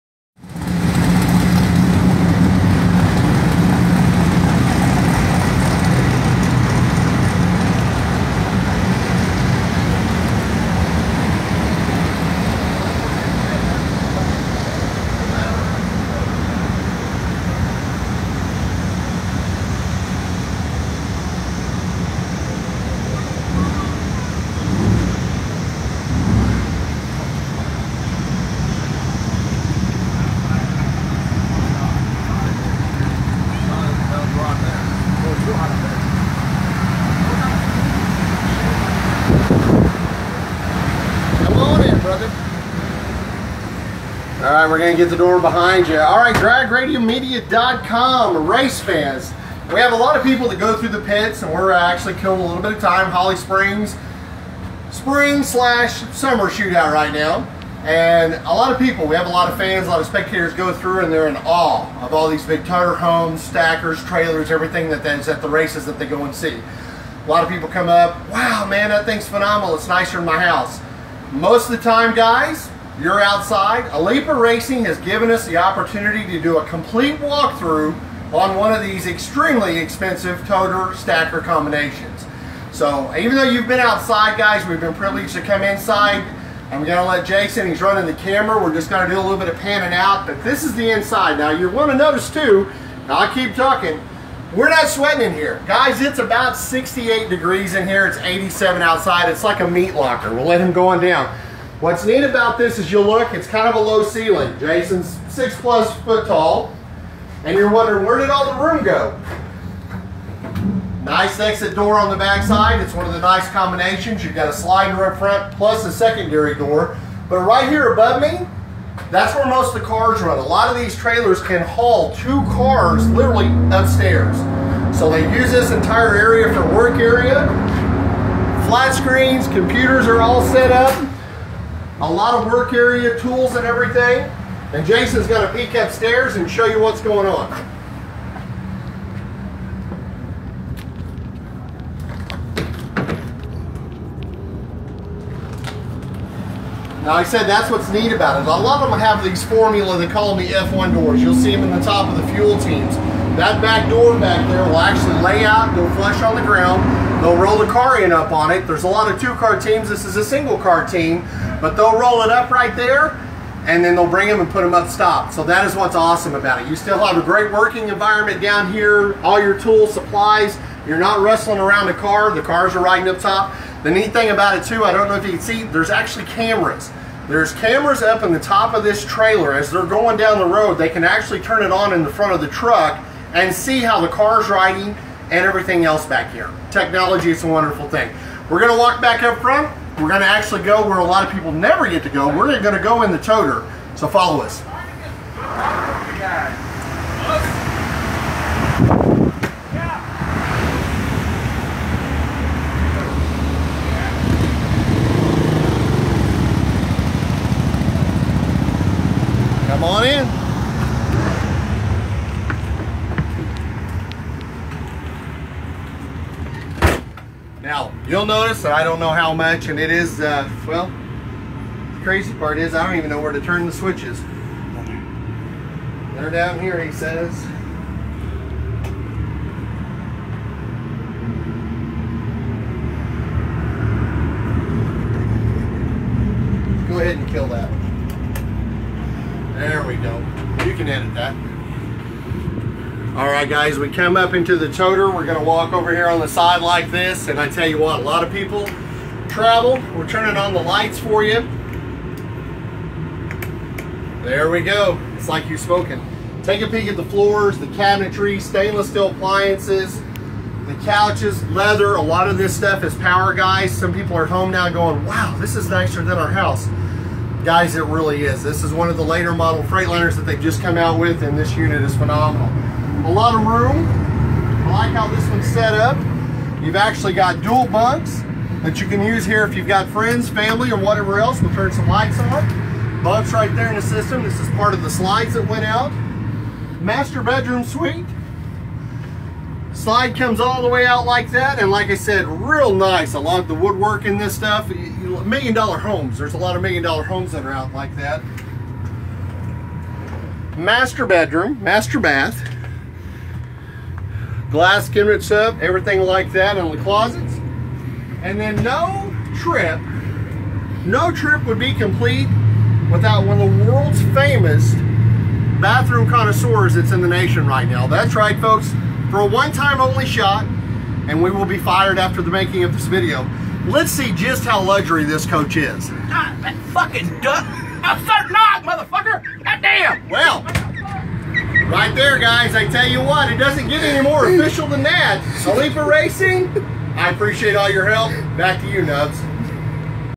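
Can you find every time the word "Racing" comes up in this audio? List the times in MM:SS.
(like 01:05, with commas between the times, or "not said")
01:14, 05:35.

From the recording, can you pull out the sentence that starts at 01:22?
So even though you've been outside guys, we've been privileged to come inside.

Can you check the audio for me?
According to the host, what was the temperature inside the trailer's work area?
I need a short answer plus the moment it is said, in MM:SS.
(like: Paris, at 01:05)
68 degrees, at 01:36.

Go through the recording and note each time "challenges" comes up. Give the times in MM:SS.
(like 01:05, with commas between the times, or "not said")
not said.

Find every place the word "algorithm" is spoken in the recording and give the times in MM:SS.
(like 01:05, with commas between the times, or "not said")
not said.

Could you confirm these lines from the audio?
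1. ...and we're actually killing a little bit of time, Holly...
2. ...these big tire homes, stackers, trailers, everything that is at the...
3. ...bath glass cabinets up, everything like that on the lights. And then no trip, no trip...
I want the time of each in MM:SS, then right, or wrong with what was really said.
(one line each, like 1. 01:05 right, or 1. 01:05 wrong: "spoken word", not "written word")
1. 00:51 right
2. 01:02 right
3. 05:01 wrong: "closets", not "lights".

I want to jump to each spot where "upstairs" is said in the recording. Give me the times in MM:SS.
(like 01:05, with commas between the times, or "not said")
02:03, 02:15.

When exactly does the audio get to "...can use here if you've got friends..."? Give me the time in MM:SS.
04:38.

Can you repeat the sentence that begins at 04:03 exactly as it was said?
All right, guys, we come up into the toter.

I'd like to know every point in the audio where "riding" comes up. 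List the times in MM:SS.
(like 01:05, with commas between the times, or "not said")
02:52, 03:04.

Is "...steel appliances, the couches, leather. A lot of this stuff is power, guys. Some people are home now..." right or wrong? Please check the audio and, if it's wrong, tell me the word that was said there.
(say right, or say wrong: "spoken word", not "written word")
right.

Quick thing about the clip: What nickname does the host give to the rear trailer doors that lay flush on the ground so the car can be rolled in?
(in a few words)
F1 doors.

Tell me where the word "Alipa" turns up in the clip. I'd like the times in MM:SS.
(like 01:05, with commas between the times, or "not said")
01:13, 05:35.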